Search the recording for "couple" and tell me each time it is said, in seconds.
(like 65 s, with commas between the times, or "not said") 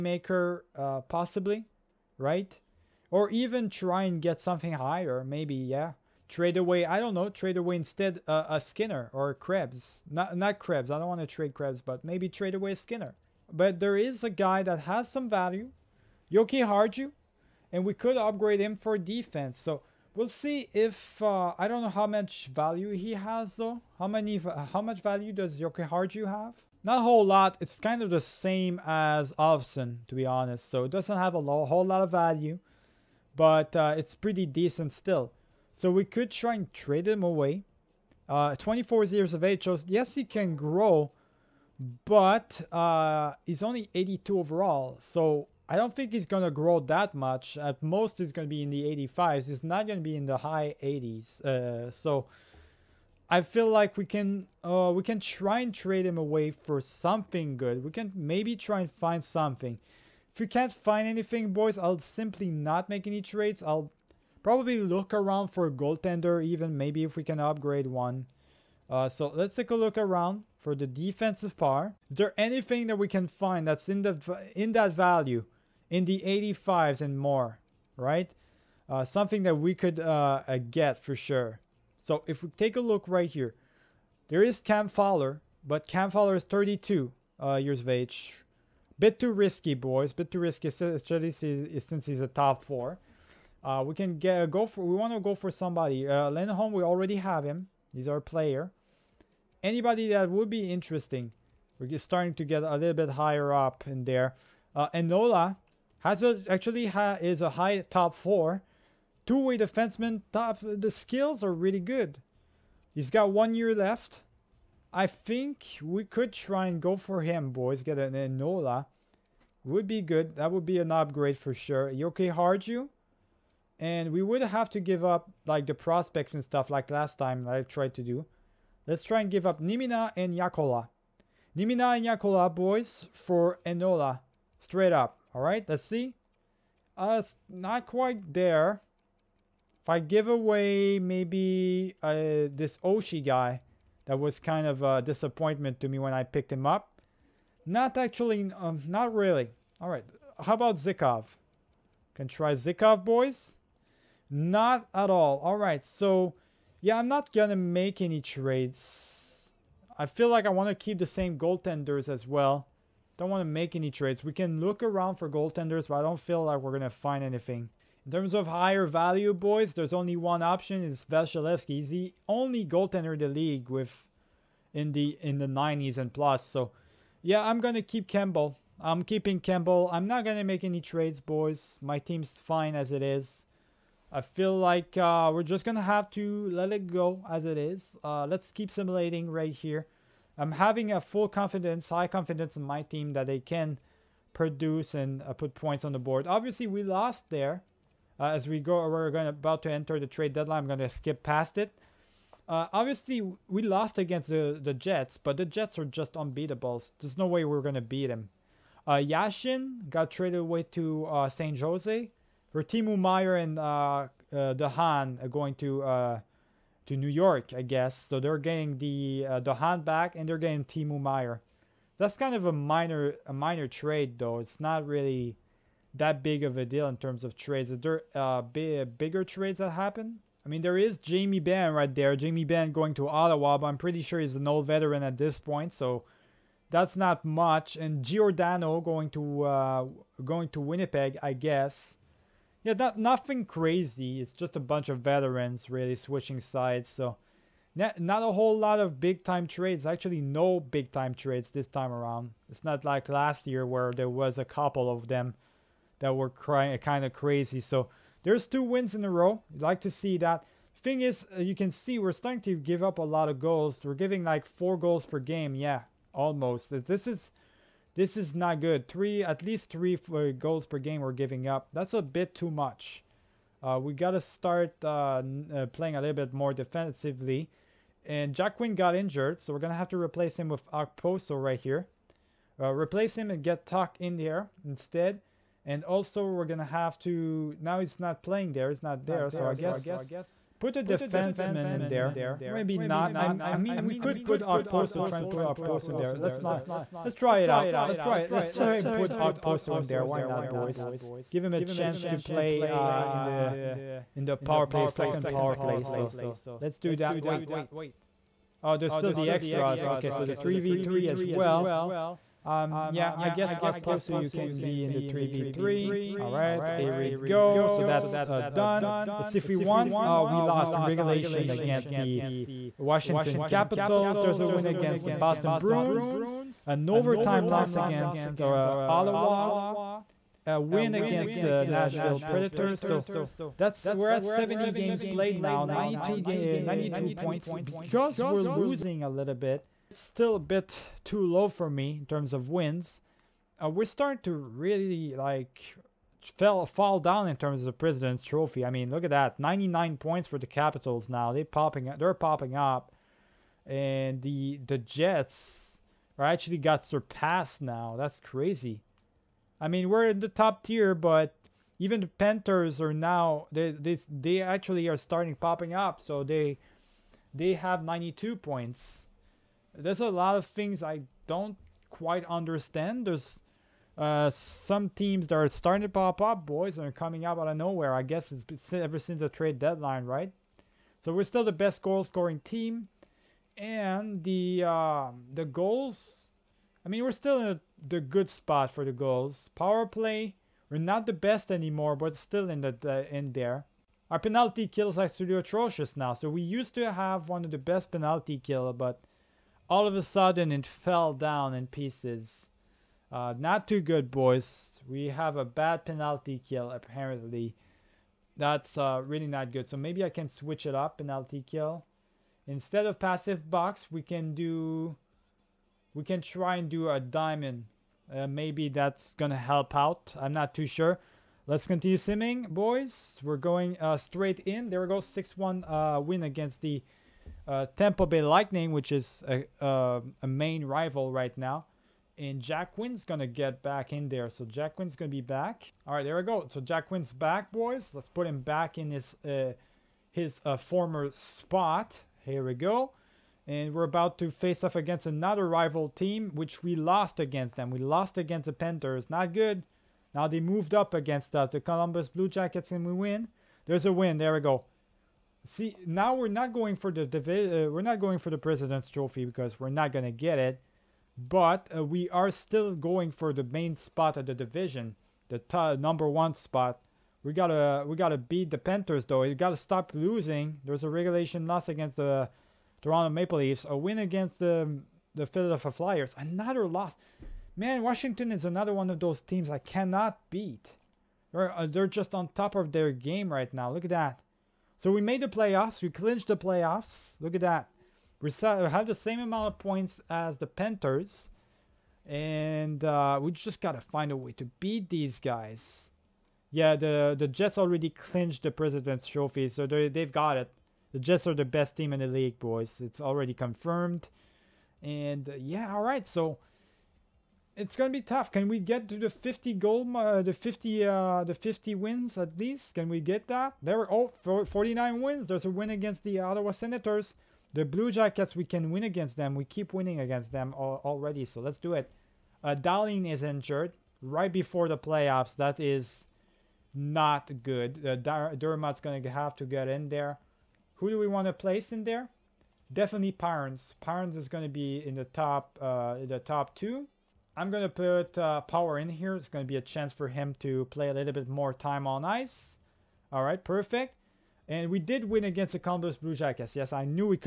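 254 s.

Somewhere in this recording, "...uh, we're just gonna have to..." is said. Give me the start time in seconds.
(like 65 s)
184 s.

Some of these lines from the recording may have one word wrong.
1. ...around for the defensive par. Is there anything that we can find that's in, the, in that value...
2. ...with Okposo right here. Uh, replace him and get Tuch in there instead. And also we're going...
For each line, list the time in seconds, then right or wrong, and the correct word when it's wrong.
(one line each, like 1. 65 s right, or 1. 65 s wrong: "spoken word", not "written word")
1. 69 s right
2. 280 s right.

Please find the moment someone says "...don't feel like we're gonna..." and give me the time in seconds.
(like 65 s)
166 s.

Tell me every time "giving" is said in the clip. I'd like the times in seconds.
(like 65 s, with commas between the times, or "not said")
263 s, 271 s.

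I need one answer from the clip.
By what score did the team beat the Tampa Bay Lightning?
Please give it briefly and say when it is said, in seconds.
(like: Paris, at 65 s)
6-1, at 425 s.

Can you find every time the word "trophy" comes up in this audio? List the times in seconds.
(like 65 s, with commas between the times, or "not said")
348 s, 458 s, 499 s.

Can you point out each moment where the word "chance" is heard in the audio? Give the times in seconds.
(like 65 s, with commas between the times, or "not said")
301 s, 539 s.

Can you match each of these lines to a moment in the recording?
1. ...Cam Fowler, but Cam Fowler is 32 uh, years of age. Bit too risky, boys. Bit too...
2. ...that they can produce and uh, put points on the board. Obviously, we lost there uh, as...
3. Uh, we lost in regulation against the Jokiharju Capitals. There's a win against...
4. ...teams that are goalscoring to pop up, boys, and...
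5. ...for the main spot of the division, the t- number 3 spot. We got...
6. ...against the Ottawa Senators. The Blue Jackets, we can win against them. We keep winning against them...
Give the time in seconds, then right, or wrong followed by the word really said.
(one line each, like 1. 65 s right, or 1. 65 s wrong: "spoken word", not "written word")
1. 84 s right
2. 193 s right
3. 320 s wrong: "Washington", not "Jokiharju"
4. 374 s wrong: "starting", not "goalscoring"
5. 463 s wrong: "1", not "3"
6. 515 s right.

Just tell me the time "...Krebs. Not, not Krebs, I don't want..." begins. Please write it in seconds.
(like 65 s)
9 s.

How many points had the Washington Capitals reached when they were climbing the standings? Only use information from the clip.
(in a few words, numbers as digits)
99.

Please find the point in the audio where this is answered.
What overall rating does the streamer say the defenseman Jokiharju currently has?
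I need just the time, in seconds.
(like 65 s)
43 s.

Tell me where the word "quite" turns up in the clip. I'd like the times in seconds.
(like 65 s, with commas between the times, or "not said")
137 s, 371 s.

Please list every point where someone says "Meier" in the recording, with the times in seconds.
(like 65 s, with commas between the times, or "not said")
212 s, 220 s.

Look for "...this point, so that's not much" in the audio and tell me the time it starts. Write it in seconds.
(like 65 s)
235 s.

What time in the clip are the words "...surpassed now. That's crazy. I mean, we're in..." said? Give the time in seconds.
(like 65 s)
356 s.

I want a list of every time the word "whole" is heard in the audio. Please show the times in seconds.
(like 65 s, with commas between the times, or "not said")
27 s, 31 s, 248 s.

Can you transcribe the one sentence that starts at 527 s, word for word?
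Uh, Dermott's gonna have to get in there.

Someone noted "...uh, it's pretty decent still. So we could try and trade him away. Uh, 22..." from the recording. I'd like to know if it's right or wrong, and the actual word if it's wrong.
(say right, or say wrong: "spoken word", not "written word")
wrong: "24", not "22".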